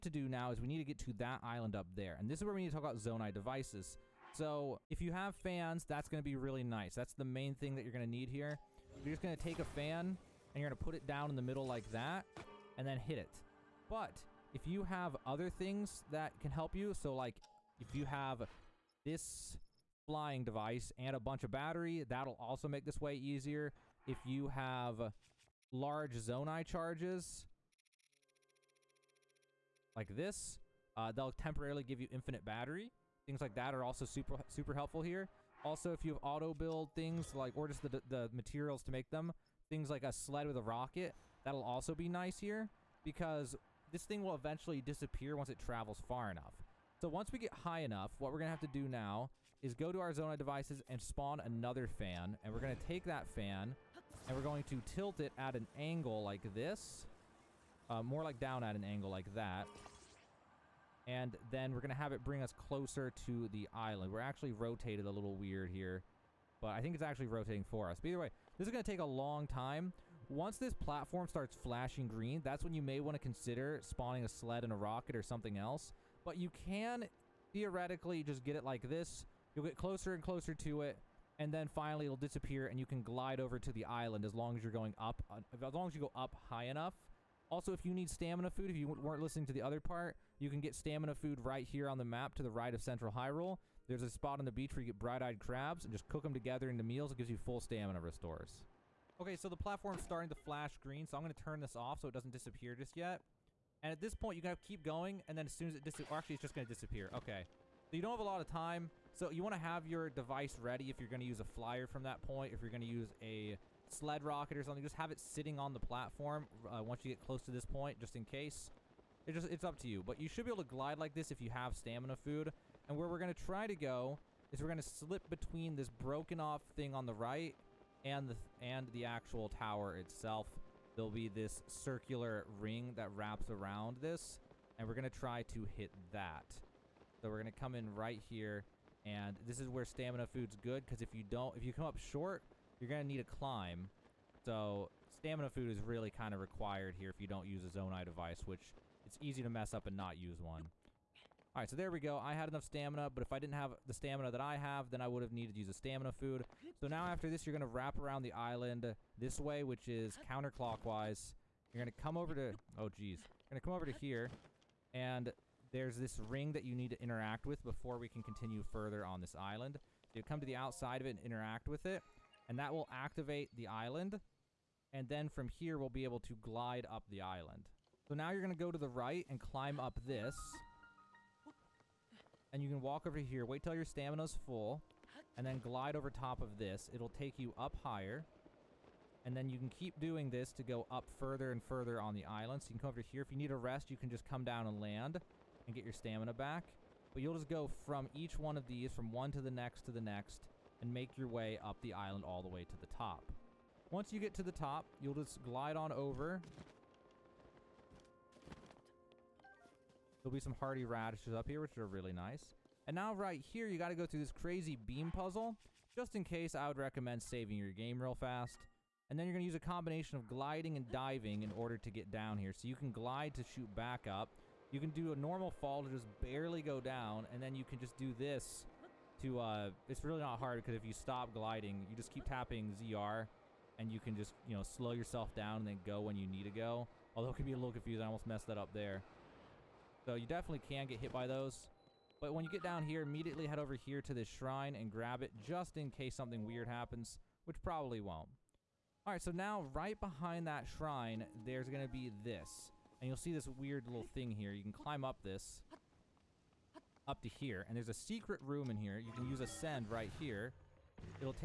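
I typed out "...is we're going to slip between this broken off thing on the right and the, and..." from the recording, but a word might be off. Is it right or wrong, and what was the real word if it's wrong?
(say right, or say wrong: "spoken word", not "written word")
right.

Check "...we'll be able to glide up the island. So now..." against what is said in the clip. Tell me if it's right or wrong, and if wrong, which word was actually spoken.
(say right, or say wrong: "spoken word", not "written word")
right.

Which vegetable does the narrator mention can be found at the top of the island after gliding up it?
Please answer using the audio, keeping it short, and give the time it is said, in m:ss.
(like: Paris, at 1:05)
Hardy radishes, at 3:30.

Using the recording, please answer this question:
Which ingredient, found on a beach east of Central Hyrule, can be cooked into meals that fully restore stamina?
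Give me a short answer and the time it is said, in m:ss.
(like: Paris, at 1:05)
Bright-eyed crabs, at 1:34.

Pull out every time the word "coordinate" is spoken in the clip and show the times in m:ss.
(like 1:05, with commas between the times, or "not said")
not said.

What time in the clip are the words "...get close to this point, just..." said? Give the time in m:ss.
1:57.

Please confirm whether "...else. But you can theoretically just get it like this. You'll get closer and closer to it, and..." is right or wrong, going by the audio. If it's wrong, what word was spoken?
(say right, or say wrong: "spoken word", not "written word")
right.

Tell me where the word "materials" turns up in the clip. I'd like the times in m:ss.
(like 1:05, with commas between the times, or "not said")
0:38.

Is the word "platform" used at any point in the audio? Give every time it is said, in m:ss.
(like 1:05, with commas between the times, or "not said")
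1:10, 1:39, 1:55.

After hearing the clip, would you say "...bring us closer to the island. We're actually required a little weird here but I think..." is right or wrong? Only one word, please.
wrong.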